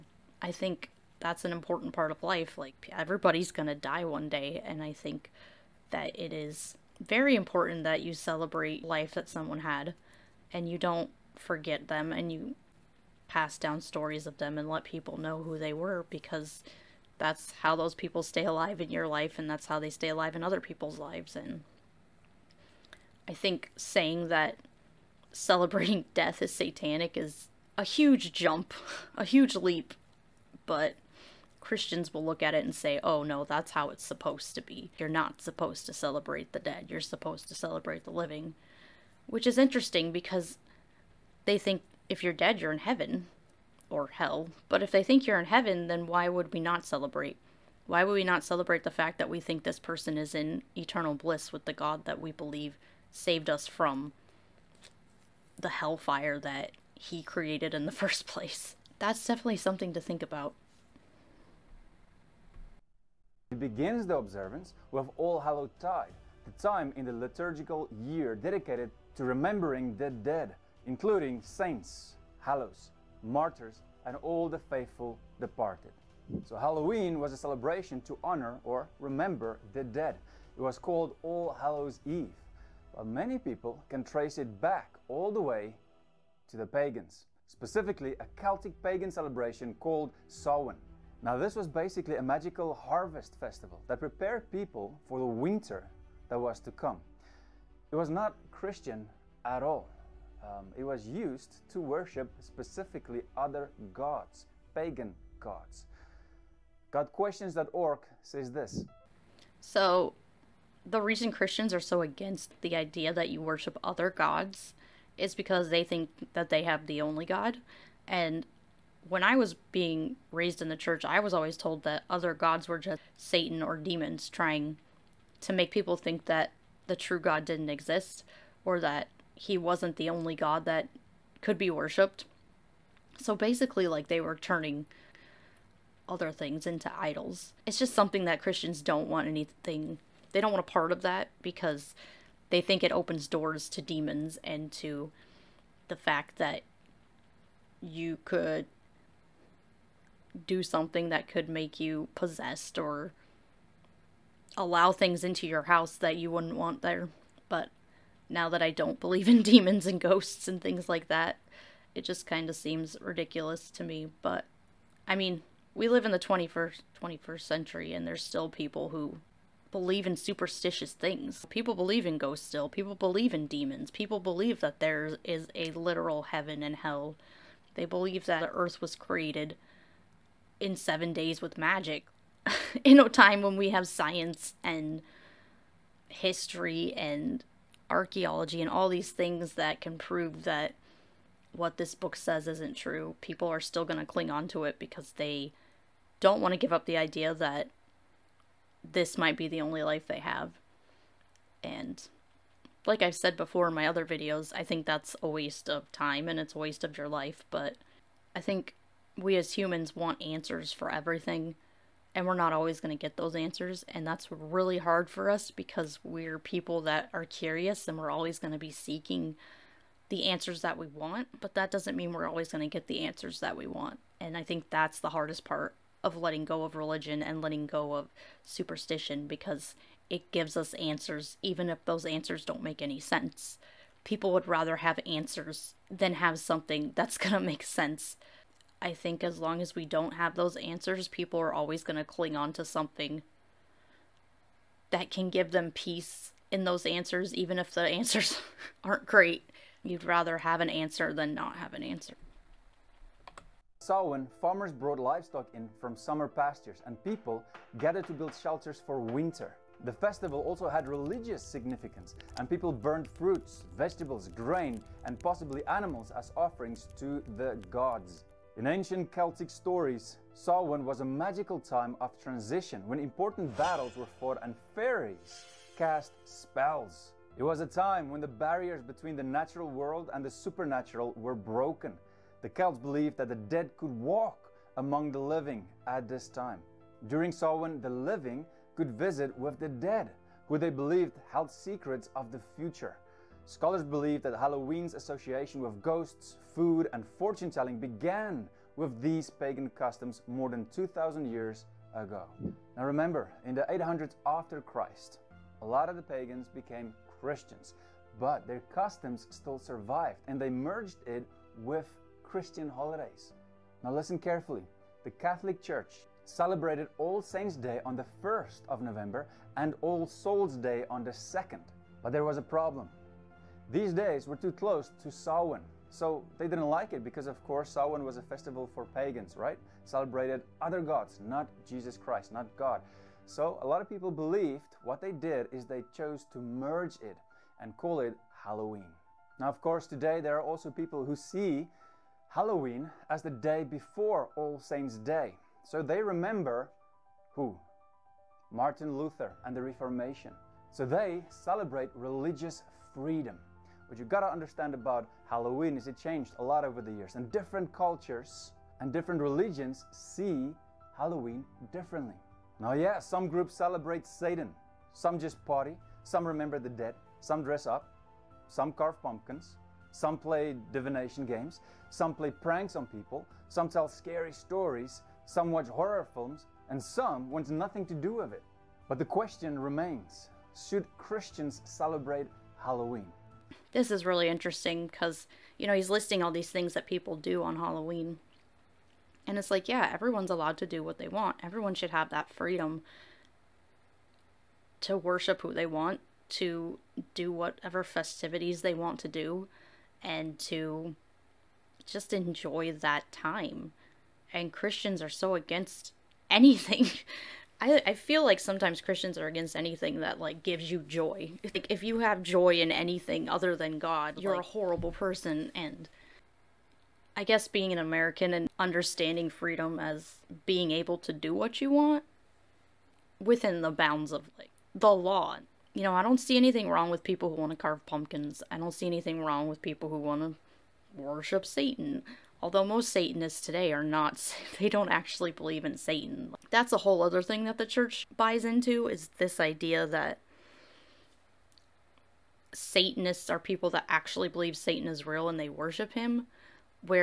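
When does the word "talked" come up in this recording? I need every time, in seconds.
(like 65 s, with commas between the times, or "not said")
not said.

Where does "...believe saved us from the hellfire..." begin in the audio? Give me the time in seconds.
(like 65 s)
52 s.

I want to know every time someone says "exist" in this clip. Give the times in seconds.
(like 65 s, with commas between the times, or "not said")
127 s.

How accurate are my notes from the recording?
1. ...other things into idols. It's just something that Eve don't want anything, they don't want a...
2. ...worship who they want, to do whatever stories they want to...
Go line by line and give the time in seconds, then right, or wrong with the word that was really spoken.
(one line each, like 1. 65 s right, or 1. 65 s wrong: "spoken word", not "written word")
1. 136 s wrong: "Christians", not "Eve"
2. 394 s wrong: "festivities", not "stories".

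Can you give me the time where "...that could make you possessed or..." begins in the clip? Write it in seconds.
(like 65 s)
151 s.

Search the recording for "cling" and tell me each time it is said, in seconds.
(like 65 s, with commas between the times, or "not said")
194 s, 242 s.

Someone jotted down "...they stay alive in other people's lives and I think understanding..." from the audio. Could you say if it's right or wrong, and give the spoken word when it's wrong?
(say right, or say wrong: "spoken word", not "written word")
wrong: "saying", not "understanding".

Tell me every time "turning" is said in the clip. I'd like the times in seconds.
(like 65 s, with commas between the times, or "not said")
134 s.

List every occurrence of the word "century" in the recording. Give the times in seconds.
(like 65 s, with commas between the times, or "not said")
167 s.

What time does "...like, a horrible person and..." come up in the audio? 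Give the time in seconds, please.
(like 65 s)
414 s.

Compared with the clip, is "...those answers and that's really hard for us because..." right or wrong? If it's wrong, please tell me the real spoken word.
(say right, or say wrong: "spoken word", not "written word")
right.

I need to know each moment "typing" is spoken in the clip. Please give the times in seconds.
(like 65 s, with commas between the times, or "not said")
not said.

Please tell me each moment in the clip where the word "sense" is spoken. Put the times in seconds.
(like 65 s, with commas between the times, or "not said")
232 s, 237 s.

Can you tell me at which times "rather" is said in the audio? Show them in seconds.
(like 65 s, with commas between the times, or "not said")
234 s, 250 s.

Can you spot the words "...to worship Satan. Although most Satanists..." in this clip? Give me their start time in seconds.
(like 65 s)
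430 s.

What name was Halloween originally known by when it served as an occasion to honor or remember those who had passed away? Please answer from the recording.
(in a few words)
All Hallows Eve.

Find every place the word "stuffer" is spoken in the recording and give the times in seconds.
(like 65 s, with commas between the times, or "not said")
not said.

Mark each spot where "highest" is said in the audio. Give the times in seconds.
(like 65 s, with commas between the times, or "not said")
not said.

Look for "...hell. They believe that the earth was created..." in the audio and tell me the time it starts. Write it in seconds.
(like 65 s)
176 s.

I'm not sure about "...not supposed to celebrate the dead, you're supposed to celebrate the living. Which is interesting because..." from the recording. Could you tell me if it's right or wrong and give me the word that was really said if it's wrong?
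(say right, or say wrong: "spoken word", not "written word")
right.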